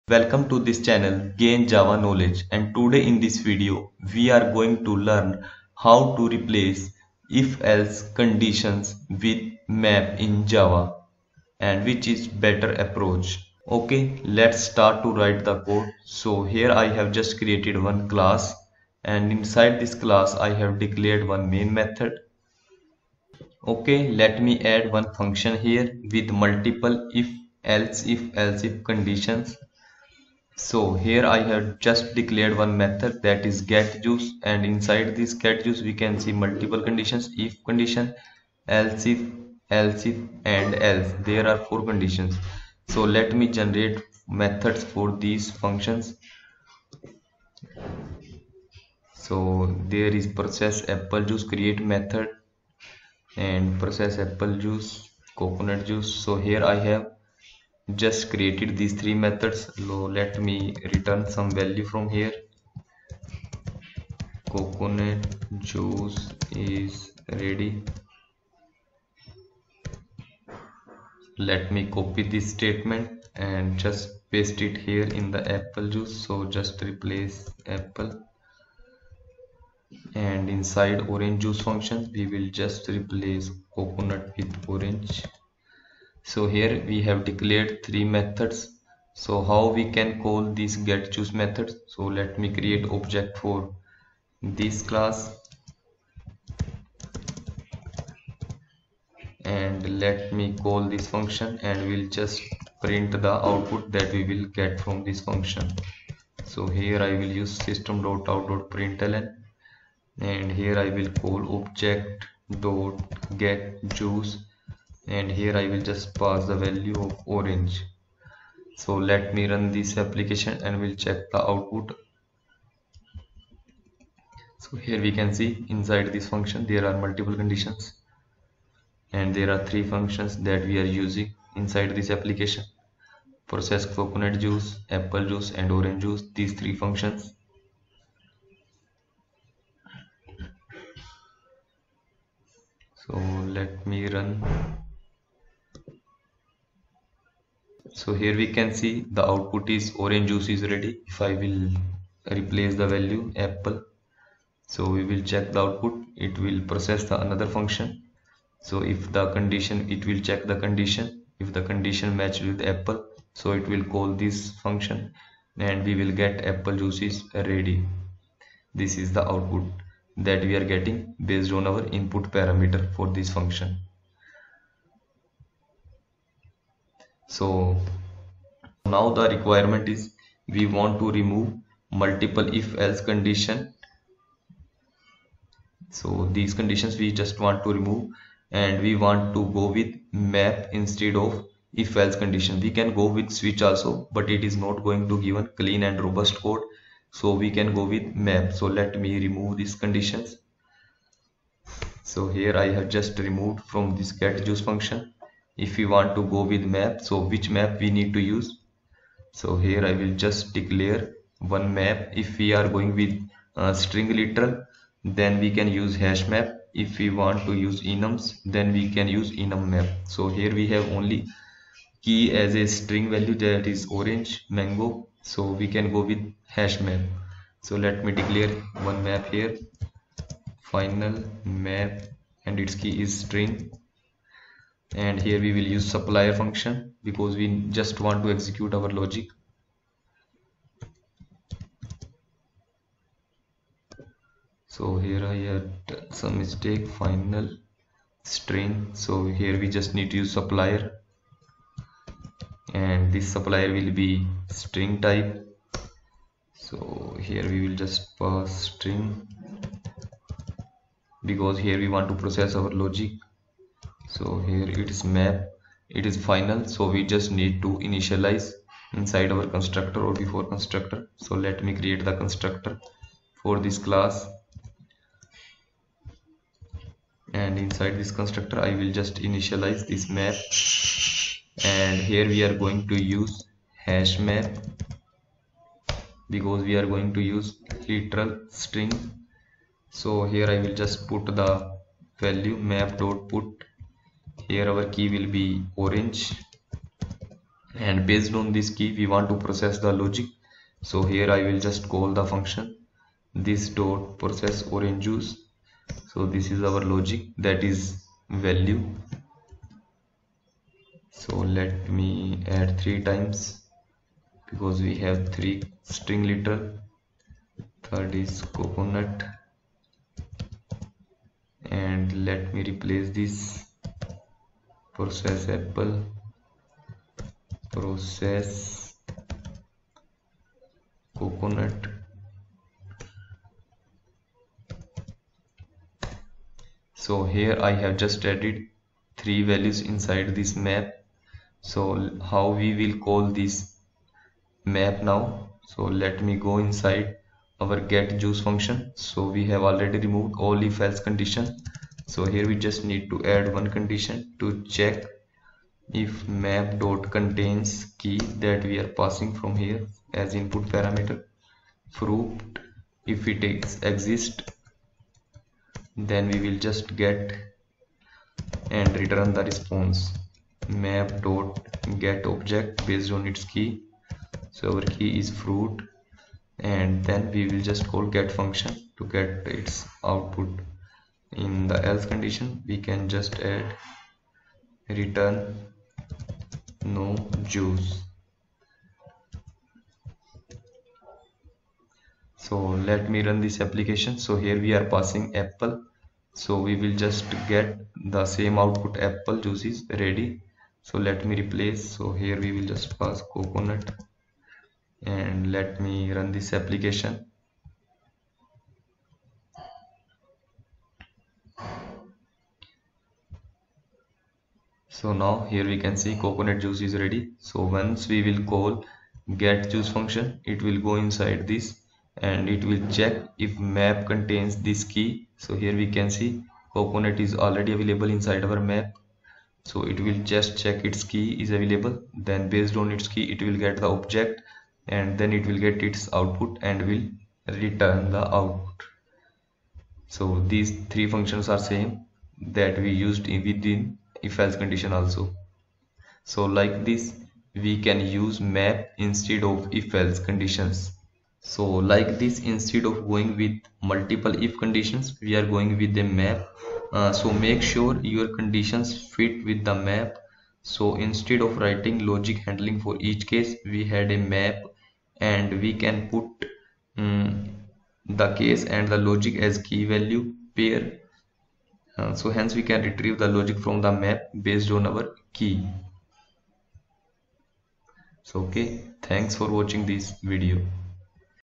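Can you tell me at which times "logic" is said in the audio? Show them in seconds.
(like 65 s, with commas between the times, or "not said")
238 s, 262 s, 300 s, 306 s, 462 s, 468 s, 473 s.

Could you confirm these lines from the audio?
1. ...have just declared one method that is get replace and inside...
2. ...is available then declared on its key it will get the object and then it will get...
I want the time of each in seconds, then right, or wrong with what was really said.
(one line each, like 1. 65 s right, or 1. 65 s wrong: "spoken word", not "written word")
1. 31 s wrong: "juice", not "replace"
2. 431 s wrong: "based", not "declared".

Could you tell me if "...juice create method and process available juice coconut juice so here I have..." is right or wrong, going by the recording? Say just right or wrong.
wrong.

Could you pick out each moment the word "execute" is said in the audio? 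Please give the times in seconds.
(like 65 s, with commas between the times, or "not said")
238 s.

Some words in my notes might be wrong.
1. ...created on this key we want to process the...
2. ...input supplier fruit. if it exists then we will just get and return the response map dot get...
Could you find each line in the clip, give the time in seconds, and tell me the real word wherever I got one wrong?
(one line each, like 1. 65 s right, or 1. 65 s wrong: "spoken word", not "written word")
1. 298 s wrong: "based", not "created"
2. 360 s wrong: "parameter", not "supplier".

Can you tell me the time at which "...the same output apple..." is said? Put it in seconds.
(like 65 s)
398 s.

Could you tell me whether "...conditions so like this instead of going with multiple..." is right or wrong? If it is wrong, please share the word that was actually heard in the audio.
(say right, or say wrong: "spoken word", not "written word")
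right.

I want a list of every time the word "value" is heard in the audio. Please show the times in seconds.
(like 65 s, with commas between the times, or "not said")
61 s, 116 s, 152 s, 223 s, 292 s, 308 s, 339 s, 469 s.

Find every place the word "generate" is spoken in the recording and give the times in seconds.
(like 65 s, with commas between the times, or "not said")
43 s.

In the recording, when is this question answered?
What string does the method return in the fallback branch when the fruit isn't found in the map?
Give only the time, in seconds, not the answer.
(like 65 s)
386 s.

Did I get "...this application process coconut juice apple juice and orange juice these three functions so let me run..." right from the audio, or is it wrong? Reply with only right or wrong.
right.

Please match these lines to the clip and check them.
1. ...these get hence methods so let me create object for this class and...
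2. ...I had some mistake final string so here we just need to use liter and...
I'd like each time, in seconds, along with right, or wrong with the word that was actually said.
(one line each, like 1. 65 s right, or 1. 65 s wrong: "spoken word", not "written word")
1. 90 s wrong: "juice", not "hence"
2. 245 s wrong: "supplier", not "liter".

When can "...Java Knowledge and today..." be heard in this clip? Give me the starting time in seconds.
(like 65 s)
1 s.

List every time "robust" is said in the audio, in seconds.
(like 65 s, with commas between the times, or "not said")
196 s.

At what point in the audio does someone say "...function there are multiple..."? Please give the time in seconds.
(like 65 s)
126 s.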